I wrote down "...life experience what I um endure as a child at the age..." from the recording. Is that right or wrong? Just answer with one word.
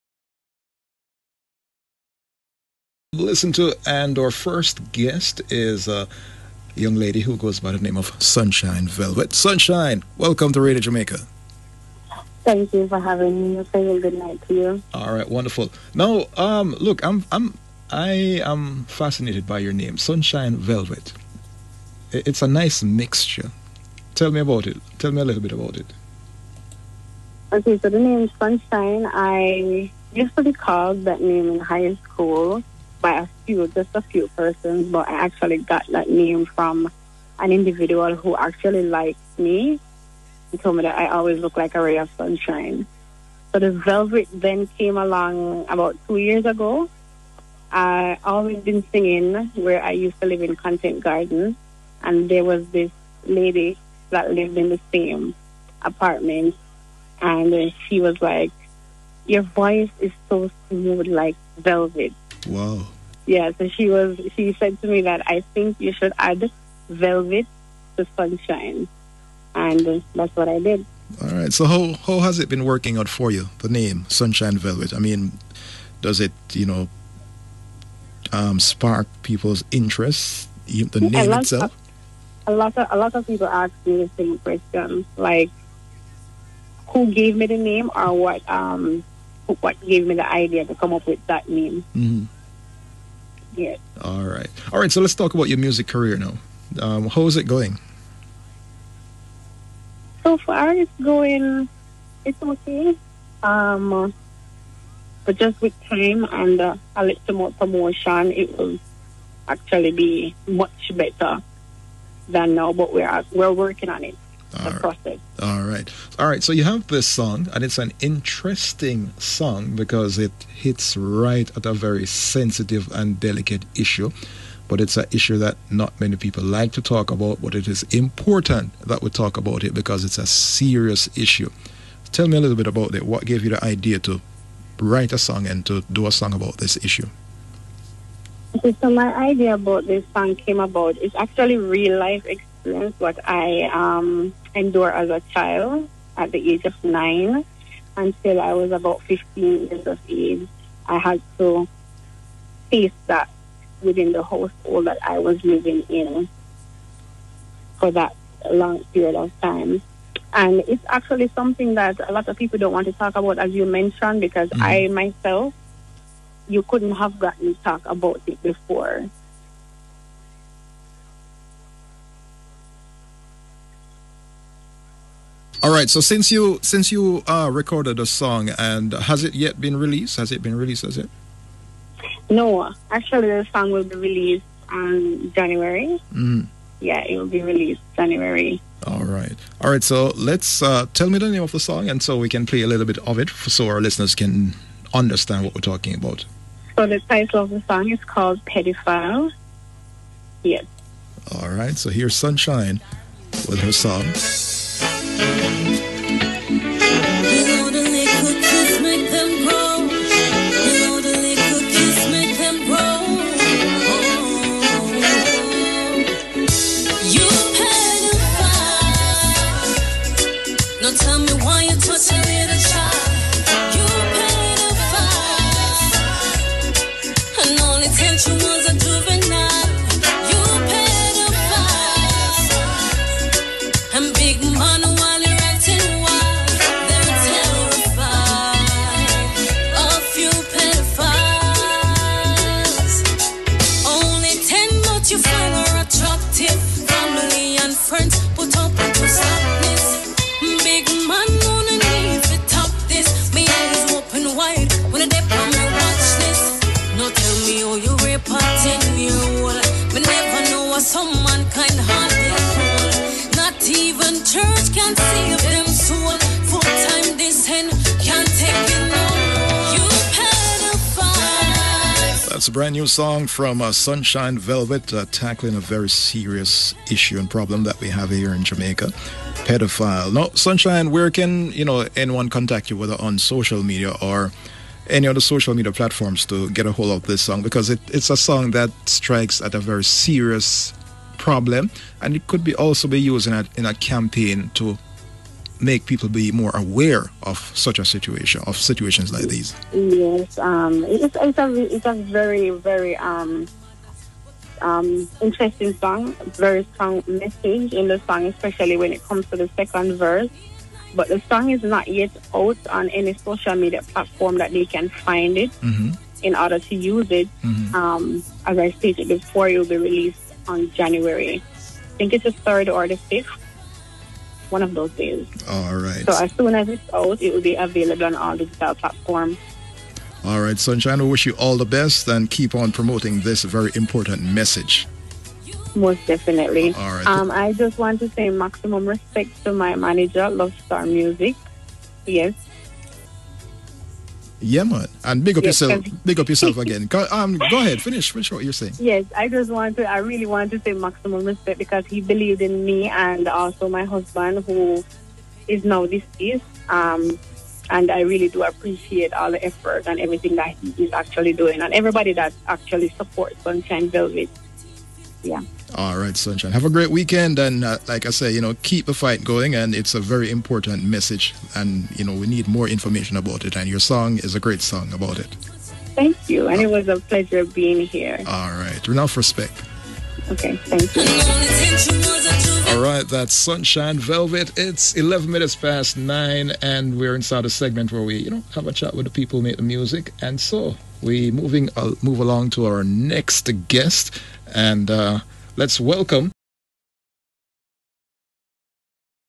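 right.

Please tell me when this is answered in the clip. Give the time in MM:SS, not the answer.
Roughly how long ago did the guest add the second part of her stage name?
00:46.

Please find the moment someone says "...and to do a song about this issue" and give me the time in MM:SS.
02:15.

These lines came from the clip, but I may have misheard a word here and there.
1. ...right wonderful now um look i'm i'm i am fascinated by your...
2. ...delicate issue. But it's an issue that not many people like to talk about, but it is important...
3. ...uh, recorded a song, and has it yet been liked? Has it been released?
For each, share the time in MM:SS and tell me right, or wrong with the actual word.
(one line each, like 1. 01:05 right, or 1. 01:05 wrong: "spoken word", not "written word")
1. 00:15 right
2. 02:03 right
3. 02:57 wrong: "released", not "liked".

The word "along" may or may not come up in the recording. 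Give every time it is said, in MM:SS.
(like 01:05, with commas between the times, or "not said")
00:44, 06:32.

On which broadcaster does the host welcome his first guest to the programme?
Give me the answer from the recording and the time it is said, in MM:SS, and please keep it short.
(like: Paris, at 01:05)
Radio Jamaica, at 00:10.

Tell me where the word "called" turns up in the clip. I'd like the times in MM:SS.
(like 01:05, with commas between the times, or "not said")
00:30, 03:18.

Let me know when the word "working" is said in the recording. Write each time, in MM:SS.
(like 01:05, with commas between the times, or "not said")
01:12, 01:53.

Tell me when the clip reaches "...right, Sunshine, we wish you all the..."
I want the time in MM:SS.
05:30.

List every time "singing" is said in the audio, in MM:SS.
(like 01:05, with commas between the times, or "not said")
00:48.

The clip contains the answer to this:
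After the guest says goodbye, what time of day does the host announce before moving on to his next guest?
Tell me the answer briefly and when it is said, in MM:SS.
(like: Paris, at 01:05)
11 minutes past 9, at 06:24.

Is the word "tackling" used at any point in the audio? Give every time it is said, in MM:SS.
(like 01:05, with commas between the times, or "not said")
04:35.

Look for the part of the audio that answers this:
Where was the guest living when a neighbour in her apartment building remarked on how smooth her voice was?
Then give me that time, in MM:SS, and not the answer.
00:50.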